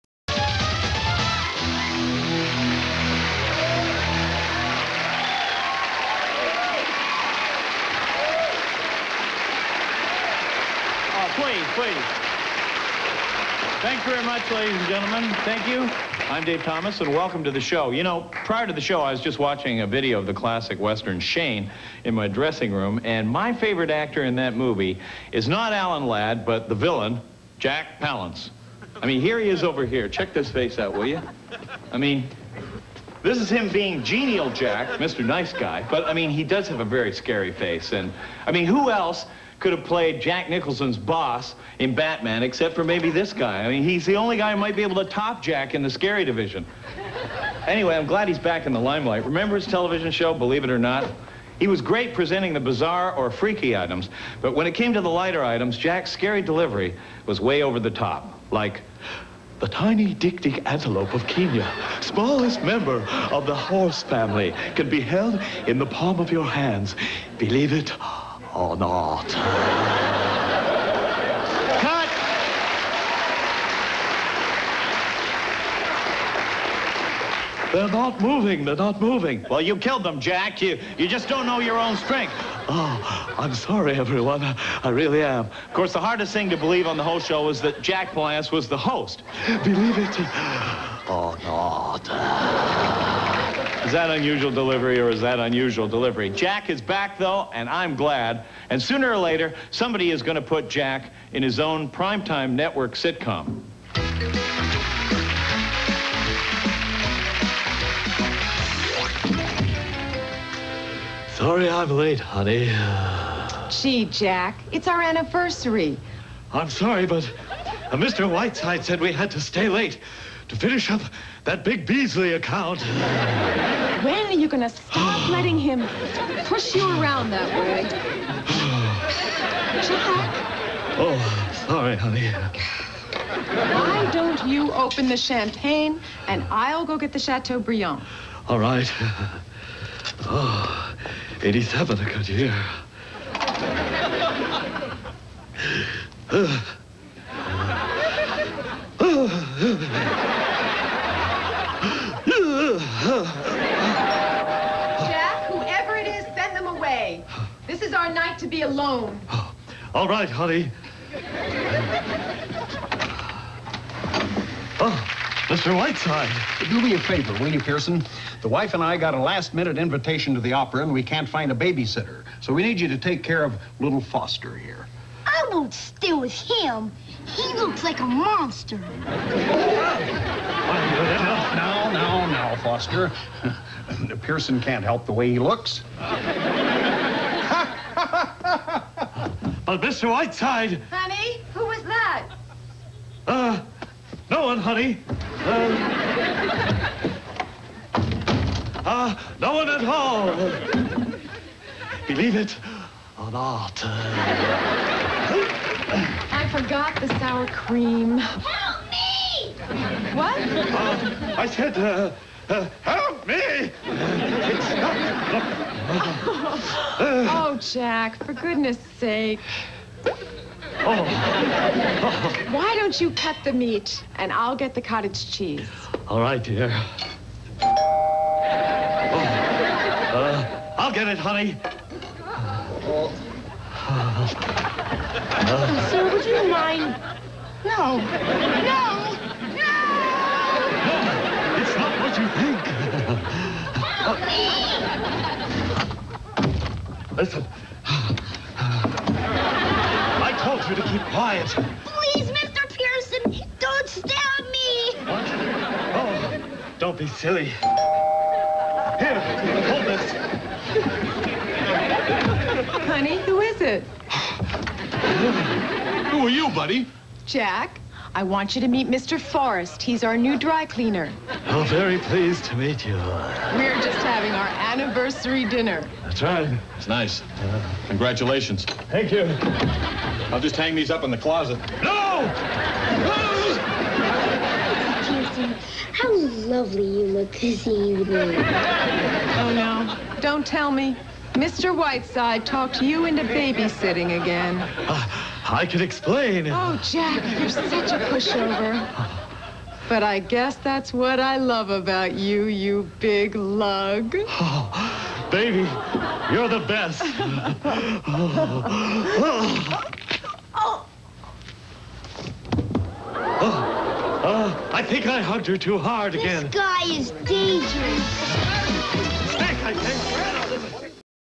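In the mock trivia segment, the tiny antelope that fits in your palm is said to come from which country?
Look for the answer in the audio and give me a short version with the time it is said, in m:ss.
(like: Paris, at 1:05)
Kenya, at 1:01.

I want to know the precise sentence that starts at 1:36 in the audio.
Jack is back, though, and I'm glad.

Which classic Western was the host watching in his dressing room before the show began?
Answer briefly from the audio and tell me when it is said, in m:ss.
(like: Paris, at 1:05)
Shane, at 0:21.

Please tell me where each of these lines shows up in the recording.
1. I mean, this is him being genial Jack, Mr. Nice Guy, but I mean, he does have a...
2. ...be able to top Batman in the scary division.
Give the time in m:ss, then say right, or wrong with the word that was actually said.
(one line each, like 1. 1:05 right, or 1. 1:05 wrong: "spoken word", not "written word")
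1. 0:31 right
2. 0:44 wrong: "Jack", not "Batman".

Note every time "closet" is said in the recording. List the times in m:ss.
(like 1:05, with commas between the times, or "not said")
4:41.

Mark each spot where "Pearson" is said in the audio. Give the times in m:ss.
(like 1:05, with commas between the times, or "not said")
2:47, 3:04, 4:12.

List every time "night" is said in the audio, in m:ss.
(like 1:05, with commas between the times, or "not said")
2:38.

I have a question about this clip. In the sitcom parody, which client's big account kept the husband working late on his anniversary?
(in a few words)
Beasley.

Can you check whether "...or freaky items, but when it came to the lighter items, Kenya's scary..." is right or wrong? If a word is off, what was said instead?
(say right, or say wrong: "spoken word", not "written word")
wrong: "Jack", not "Kenya".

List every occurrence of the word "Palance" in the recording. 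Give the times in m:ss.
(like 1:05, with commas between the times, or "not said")
0:28, 1:28.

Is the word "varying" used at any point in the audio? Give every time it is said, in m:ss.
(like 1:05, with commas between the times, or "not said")
not said.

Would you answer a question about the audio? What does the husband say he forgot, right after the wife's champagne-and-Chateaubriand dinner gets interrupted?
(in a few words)
sour cream.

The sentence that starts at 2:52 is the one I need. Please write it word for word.
So we need you to take care of little Foster here.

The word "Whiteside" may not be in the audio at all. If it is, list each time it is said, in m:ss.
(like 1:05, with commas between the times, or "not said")
1:58, 2:45, 3:10, 4:51.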